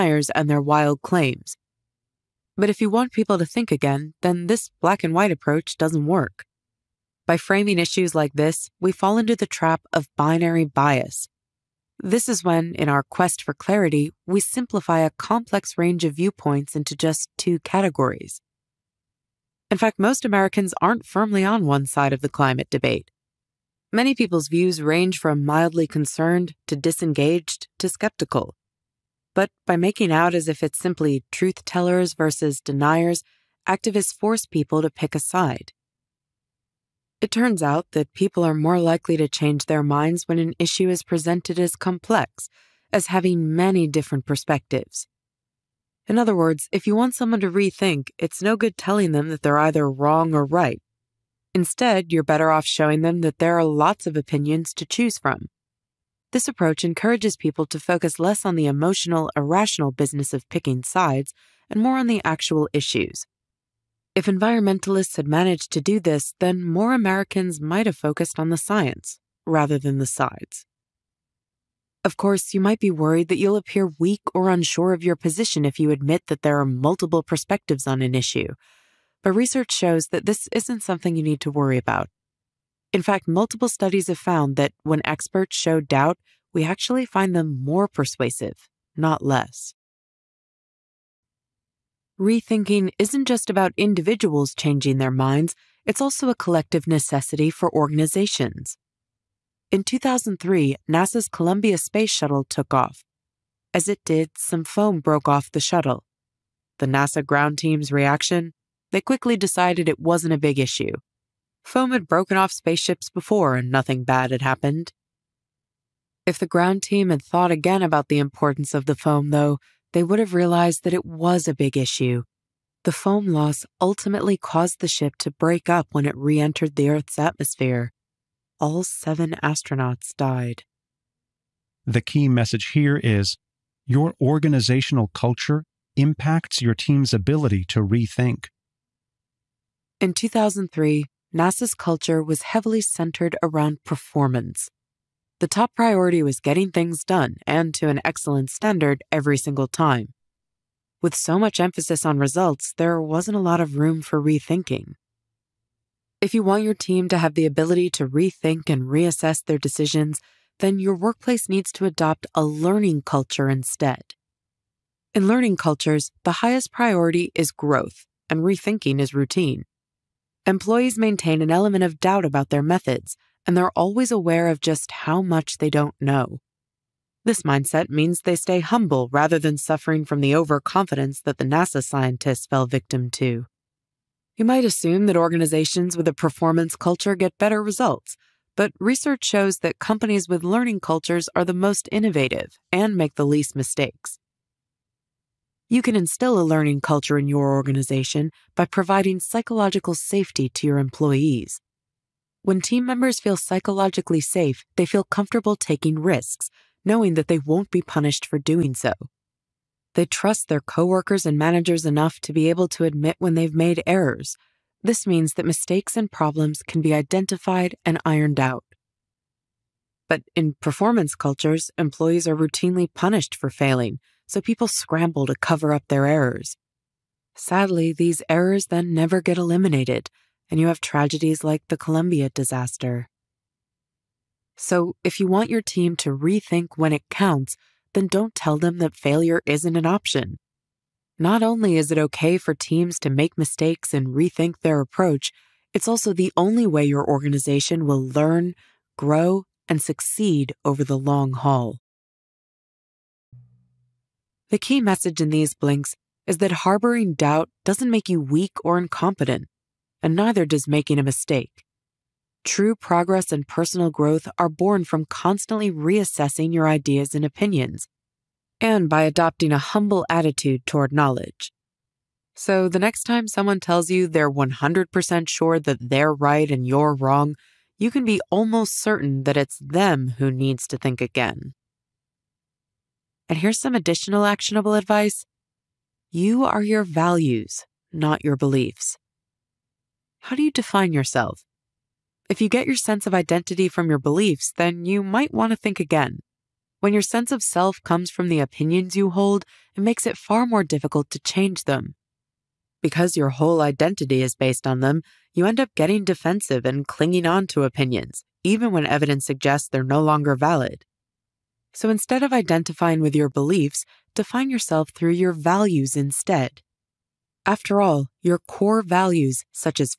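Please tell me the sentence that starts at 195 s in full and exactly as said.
You can instill a learning culture in your organization by providing psychological safety to your employees.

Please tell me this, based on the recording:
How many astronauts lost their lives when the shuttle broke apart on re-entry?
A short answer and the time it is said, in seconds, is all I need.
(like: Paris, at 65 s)
7, at 128 s.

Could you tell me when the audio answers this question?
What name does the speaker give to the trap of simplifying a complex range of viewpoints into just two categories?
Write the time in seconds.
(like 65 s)
10 s.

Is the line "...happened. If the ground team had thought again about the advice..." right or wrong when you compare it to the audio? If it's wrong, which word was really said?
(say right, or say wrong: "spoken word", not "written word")
wrong: "importance", not "advice".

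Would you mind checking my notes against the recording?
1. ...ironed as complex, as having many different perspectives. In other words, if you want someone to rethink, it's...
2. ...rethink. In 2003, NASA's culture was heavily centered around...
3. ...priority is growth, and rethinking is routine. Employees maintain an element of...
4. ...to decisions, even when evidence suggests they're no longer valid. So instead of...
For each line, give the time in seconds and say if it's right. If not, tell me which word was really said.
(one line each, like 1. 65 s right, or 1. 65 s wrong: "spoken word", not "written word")
1. 41 s wrong: "presented", not "ironed"
2. 137 s right
3. 166 s right
4. 307 s wrong: "opinions", not "decisions".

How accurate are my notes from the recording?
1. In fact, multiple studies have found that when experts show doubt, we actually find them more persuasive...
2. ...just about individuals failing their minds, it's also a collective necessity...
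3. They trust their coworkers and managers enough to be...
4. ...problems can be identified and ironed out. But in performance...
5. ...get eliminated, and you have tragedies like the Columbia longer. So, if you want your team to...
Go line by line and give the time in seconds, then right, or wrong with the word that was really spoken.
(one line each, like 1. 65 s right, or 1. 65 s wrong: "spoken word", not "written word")
1. 82 s right
2. 93 s wrong: "changing", not "failing"
3. 209 s right
4. 216 s right
5. 229 s wrong: "disaster", not "longer".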